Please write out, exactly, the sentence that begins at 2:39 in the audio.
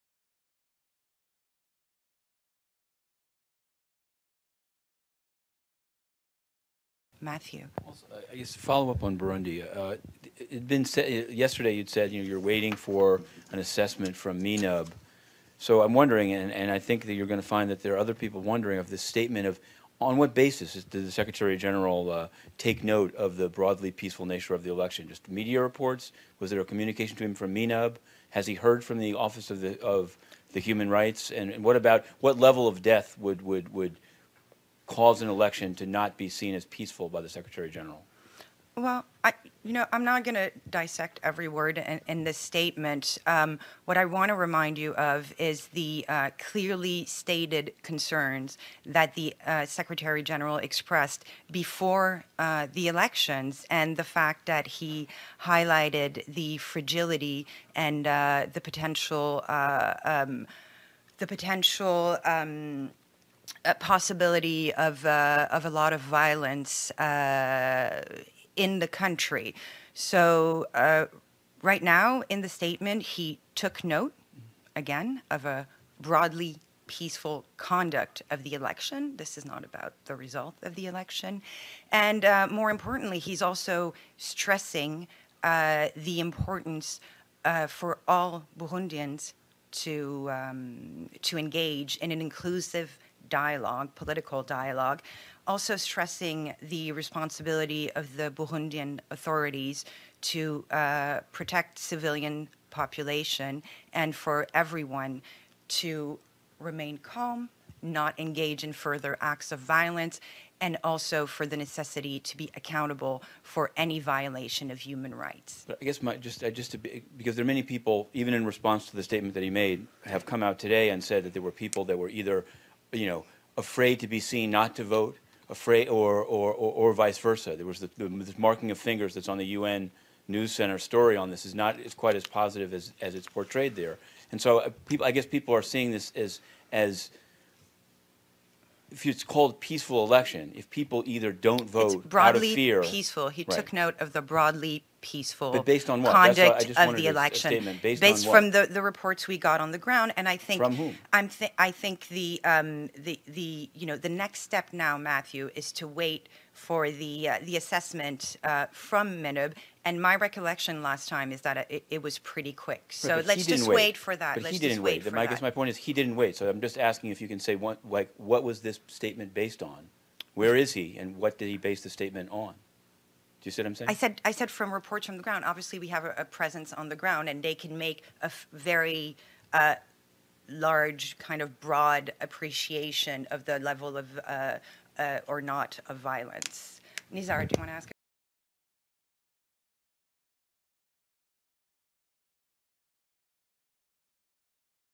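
And my recollection last time is that it, it was pretty quick.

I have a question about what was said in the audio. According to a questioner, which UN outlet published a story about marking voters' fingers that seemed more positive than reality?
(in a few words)
UN News Center.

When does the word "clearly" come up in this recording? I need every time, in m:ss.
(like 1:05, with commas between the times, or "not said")
0:46.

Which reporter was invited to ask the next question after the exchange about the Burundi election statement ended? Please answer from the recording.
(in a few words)
Nizar.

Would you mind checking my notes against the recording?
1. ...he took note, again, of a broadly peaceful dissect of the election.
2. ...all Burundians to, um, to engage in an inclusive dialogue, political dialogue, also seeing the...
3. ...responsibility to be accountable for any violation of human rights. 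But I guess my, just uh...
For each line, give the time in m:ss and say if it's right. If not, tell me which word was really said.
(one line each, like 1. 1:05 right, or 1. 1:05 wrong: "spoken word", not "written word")
1. 1:13 wrong: "conduct", not "dissect"
2. 1:28 wrong: "stressing", not "seeing"
3. 1:51 wrong: "necessity", not "responsibility".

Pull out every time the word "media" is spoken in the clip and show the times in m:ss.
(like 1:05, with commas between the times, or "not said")
0:25.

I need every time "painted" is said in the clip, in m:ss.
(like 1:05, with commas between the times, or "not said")
not said.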